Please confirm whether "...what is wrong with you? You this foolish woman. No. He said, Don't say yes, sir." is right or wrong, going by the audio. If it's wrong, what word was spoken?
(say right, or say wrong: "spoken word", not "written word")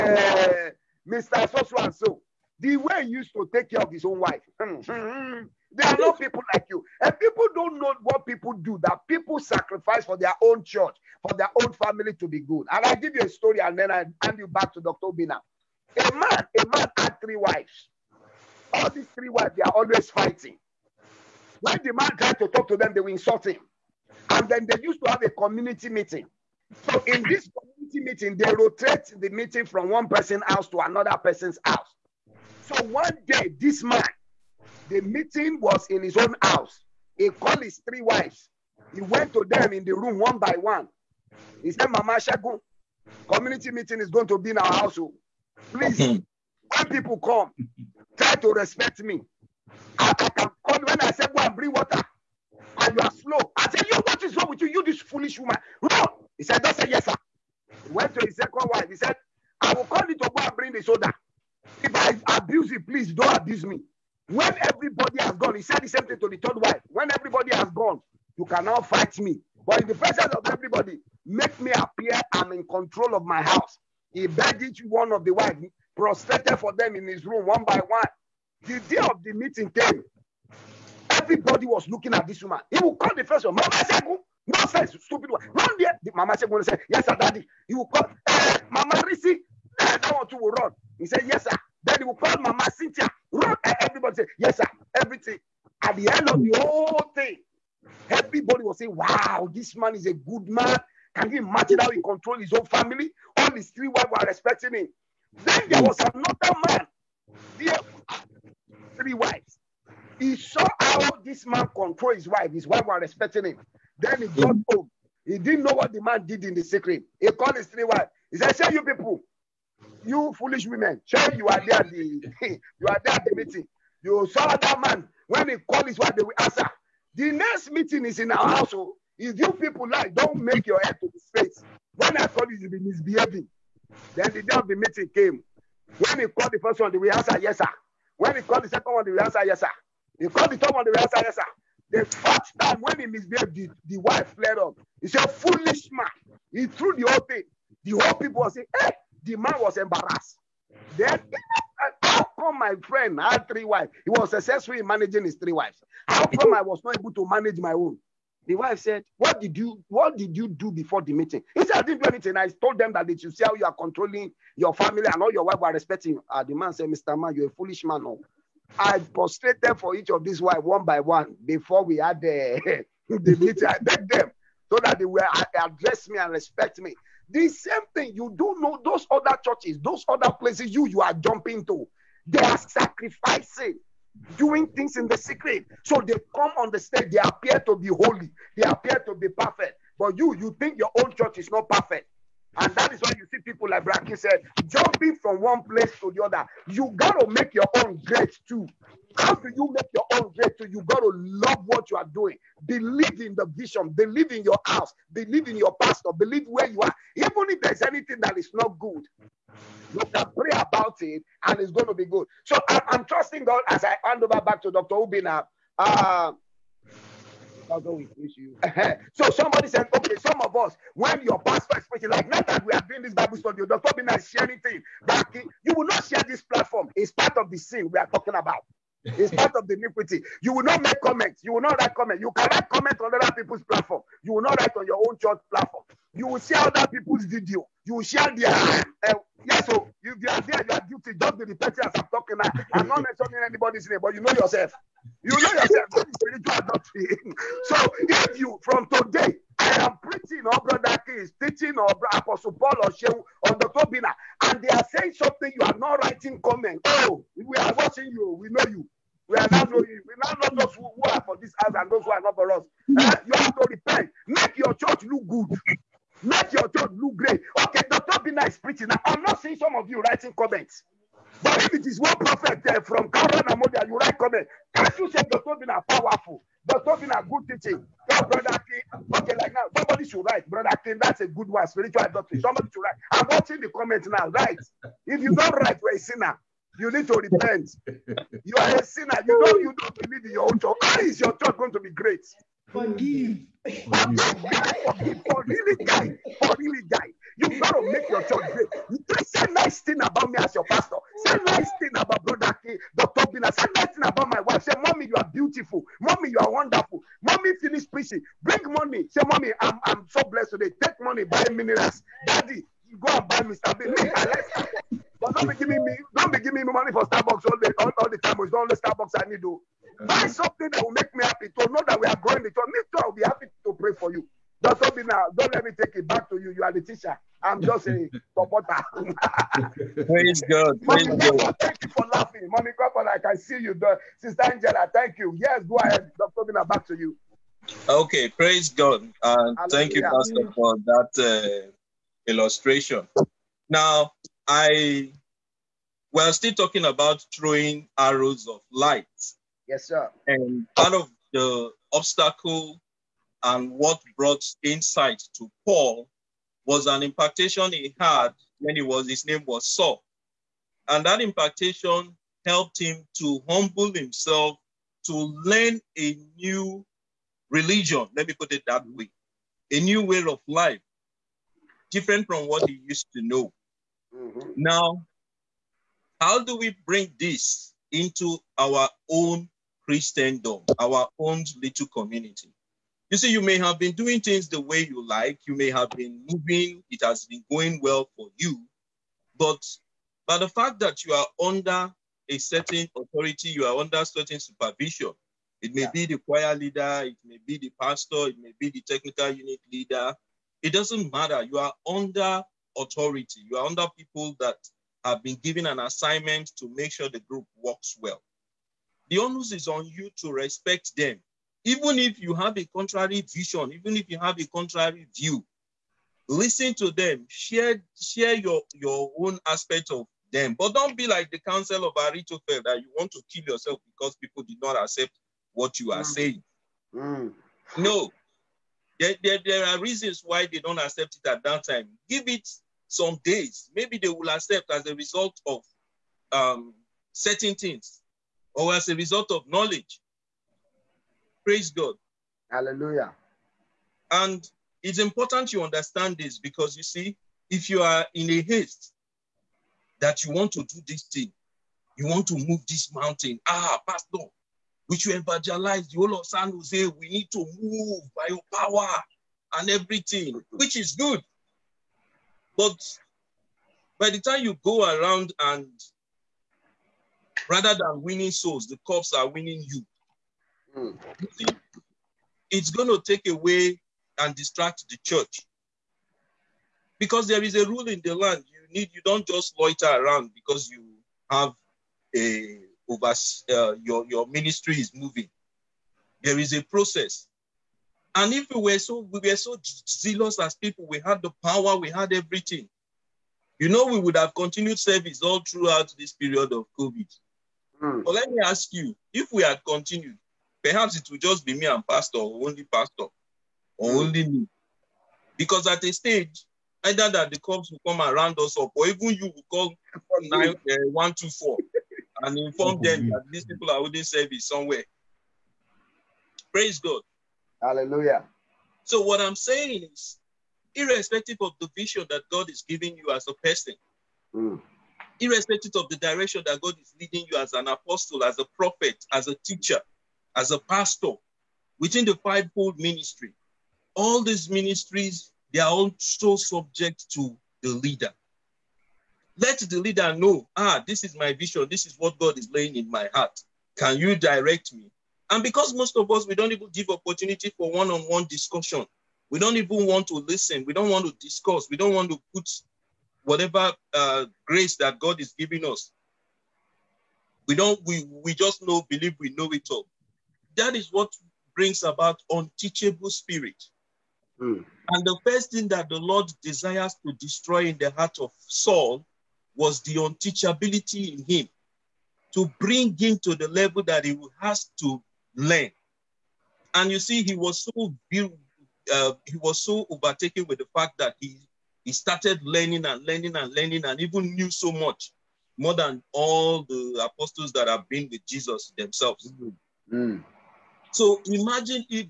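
right.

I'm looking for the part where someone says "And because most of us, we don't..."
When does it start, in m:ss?
9:05.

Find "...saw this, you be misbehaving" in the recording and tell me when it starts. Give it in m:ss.
2:12.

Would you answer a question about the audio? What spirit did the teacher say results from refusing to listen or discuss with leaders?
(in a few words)
unteachable spirit.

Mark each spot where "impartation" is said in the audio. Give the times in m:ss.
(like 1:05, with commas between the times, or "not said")
5:57, 6:01.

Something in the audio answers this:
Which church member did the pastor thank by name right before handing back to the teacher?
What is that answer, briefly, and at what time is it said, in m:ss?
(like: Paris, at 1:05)
Sister Angela, at 5:34.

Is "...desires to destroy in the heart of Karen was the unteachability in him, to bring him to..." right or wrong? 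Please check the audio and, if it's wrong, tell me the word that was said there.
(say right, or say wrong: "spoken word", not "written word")
wrong: "Saul", not "Karen".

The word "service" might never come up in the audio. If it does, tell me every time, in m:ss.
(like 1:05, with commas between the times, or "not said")
8:14, 8:34.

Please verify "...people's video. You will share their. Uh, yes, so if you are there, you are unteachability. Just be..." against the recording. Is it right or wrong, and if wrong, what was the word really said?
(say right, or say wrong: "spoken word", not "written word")
wrong: "guilty", not "unteachability".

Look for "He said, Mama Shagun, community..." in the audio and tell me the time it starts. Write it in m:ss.
0:41.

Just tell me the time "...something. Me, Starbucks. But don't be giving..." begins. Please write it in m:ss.
5:13.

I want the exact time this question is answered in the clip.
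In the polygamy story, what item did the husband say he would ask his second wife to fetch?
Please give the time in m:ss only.
1:00.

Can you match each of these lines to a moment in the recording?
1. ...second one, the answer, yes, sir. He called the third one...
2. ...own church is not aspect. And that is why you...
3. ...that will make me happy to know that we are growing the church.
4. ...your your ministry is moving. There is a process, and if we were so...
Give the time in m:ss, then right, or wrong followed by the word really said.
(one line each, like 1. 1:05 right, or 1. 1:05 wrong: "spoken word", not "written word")
1. 2:18 right
2. 3:10 wrong: "perfect", not "aspect"
3. 5:20 right
4. 8:03 right.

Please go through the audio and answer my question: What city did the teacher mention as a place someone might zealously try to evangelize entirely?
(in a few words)
San Jose.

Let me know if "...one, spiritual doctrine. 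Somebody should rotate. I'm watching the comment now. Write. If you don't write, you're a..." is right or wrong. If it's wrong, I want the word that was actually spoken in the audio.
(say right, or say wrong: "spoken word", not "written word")
wrong: "write", not "rotate".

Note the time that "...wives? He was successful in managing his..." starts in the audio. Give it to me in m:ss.
2:33.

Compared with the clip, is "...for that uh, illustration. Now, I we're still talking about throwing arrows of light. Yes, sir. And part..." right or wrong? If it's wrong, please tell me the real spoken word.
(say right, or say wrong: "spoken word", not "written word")
right.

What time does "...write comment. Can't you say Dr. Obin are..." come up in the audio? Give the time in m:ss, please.
4:33.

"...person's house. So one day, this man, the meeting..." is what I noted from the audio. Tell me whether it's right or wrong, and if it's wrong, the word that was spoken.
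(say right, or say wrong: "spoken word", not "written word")
right.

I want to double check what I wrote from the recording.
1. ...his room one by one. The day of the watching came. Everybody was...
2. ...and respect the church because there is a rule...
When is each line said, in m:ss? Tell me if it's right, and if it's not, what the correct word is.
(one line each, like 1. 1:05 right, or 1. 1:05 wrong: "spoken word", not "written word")
1. 1:17 wrong: "meeting", not "watching"
2. 7:54 wrong: "distract", not "respect".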